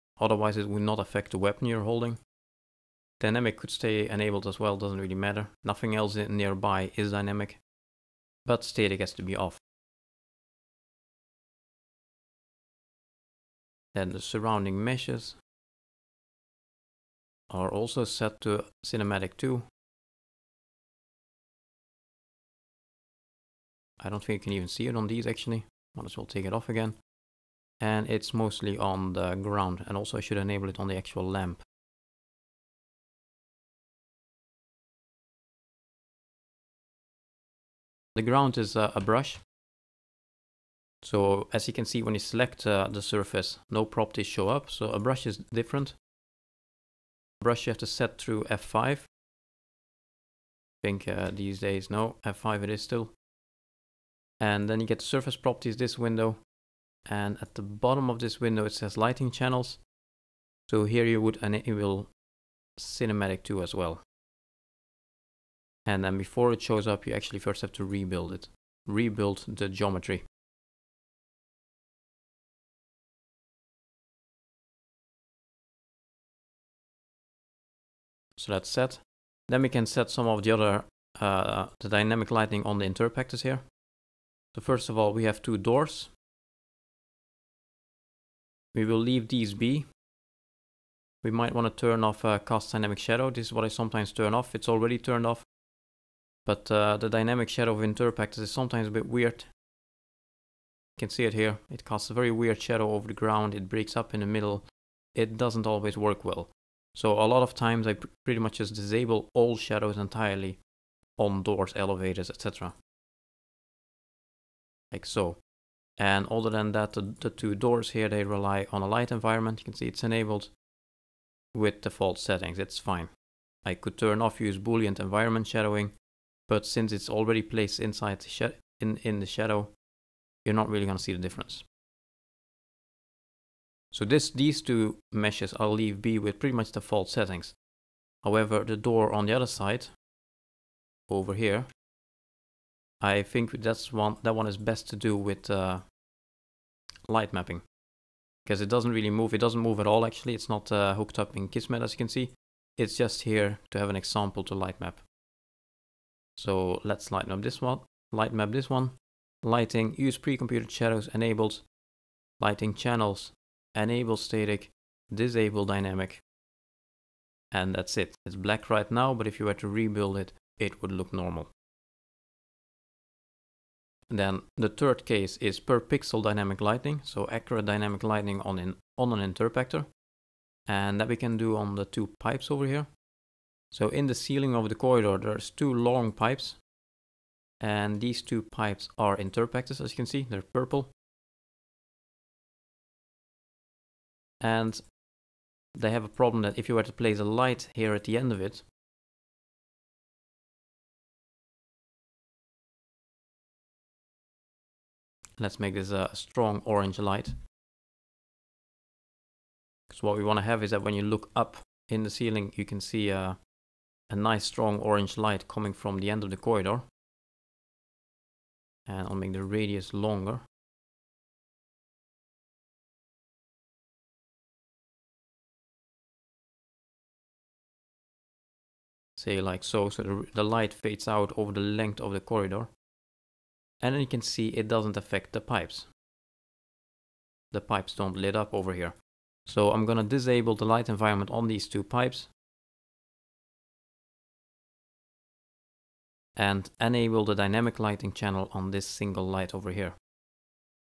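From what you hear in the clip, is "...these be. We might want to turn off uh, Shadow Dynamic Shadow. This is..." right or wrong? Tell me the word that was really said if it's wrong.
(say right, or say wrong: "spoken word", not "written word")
wrong: "Cast", not "Shadow".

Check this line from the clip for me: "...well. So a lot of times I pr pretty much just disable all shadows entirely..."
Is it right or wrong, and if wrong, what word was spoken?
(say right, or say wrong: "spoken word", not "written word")
right.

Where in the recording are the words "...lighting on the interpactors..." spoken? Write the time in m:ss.
1:22.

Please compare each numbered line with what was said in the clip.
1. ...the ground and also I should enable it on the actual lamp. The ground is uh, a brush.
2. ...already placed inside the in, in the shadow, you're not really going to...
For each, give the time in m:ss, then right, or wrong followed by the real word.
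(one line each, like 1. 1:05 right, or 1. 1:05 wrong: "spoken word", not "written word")
1. 0:29 right
2. 2:07 right.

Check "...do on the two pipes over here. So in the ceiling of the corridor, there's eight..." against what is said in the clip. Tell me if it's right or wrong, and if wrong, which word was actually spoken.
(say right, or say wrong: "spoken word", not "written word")
wrong: "two", not "eight".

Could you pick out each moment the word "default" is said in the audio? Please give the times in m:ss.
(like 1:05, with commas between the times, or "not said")
2:01, 2:16.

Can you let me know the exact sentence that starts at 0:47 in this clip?
Brush you have to set through F5.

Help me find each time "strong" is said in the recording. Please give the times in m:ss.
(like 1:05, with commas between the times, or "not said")
3:26, 3:34.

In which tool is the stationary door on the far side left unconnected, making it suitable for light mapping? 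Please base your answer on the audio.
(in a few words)
Kismet.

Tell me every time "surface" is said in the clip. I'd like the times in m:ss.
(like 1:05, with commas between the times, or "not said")
0:43, 0:54.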